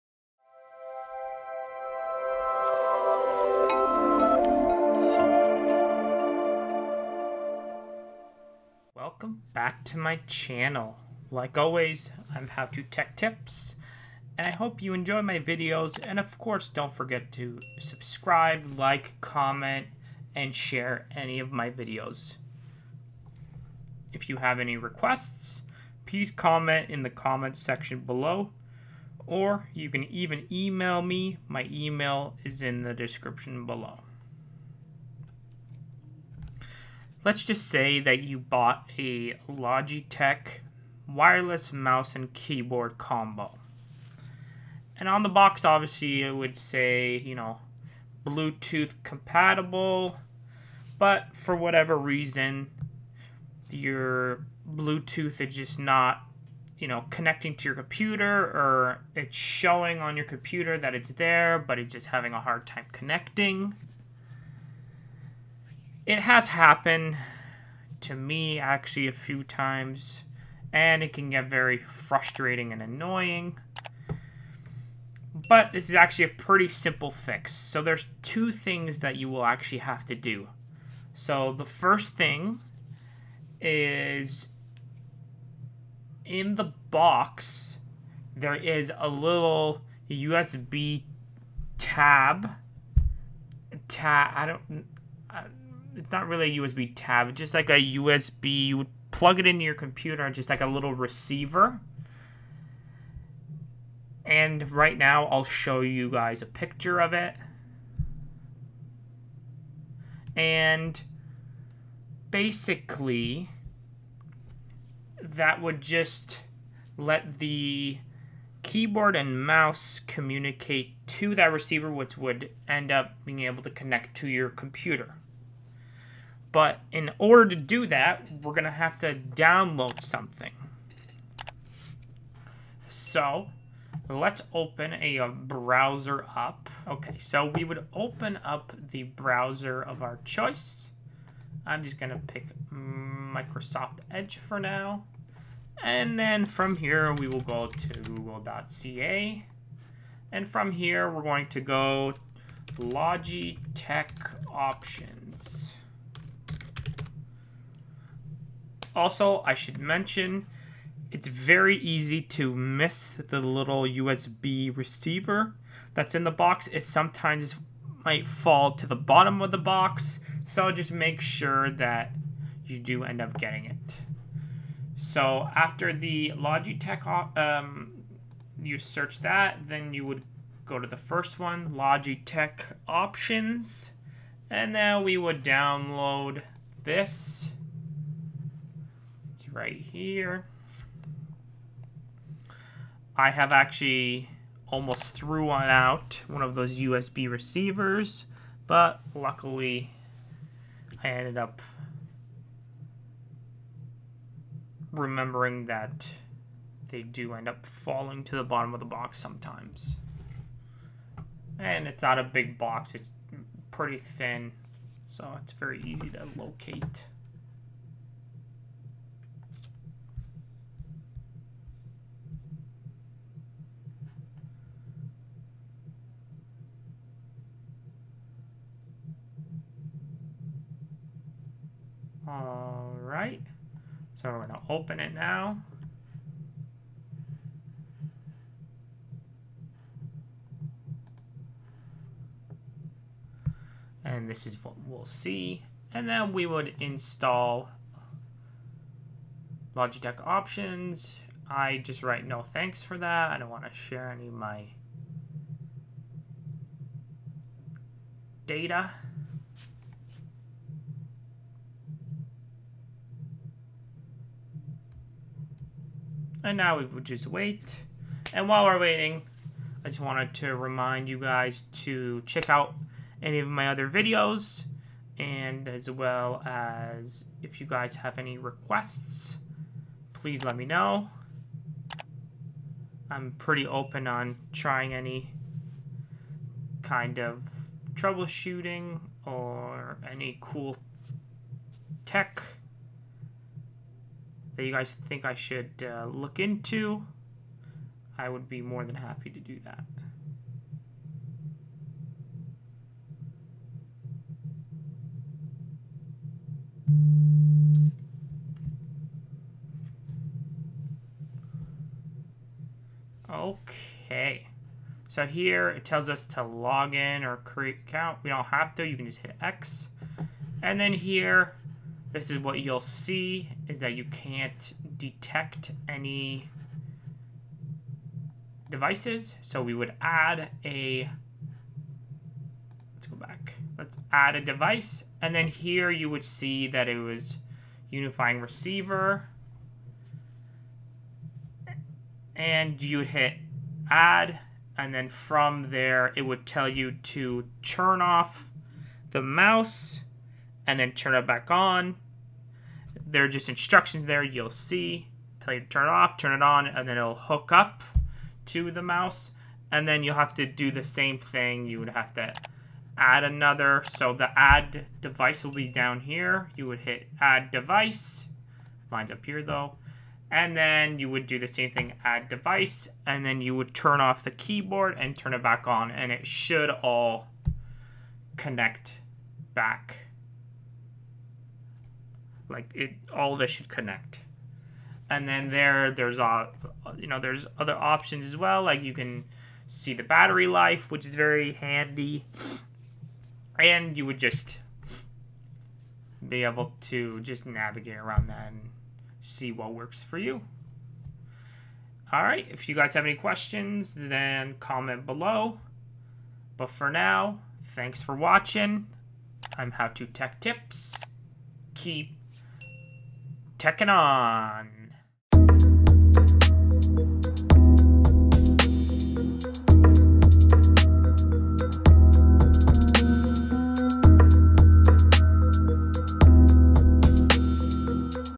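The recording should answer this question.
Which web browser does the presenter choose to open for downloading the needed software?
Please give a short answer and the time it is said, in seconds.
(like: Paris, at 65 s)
Microsoft Edge, at 142 s.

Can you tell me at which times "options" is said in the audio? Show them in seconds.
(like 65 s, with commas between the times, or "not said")
154 s, 182 s, 250 s, 387 s.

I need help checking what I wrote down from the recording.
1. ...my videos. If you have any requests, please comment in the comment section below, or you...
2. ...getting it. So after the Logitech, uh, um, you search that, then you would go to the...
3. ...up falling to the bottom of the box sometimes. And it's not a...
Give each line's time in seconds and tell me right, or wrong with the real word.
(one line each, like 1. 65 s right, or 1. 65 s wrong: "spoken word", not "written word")
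1. 21 s right
2. 173 s right
3. 207 s right.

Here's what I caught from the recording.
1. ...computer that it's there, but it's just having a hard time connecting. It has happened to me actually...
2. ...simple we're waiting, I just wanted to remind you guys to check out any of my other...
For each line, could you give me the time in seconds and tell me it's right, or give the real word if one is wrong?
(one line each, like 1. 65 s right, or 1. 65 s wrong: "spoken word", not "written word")
1. 60 s right
2. 268 s wrong: "while", not "simple".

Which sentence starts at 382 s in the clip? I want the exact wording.
Like it, all this should connect.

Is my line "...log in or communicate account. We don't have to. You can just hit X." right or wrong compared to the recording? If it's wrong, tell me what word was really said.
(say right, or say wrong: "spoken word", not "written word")
wrong: "create", not "communicate".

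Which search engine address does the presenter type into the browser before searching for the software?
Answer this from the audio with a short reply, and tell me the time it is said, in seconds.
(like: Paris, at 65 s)
google.ca, at 147 s.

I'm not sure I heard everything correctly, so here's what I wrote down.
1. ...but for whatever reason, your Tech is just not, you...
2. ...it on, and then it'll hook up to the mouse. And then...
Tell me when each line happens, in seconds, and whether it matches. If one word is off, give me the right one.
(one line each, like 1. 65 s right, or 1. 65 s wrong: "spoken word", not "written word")
1. 50 s wrong: "Bluetooth", not "Tech"
2. 356 s right.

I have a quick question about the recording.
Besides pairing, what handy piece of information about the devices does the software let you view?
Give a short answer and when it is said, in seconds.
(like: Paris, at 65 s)
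Battery life, at 390 s.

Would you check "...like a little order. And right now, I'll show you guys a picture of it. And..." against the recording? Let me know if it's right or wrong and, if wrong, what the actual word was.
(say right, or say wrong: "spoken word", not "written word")
wrong: "receiver", not "order".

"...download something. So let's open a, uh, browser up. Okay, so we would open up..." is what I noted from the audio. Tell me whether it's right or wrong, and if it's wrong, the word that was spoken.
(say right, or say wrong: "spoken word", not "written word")
right.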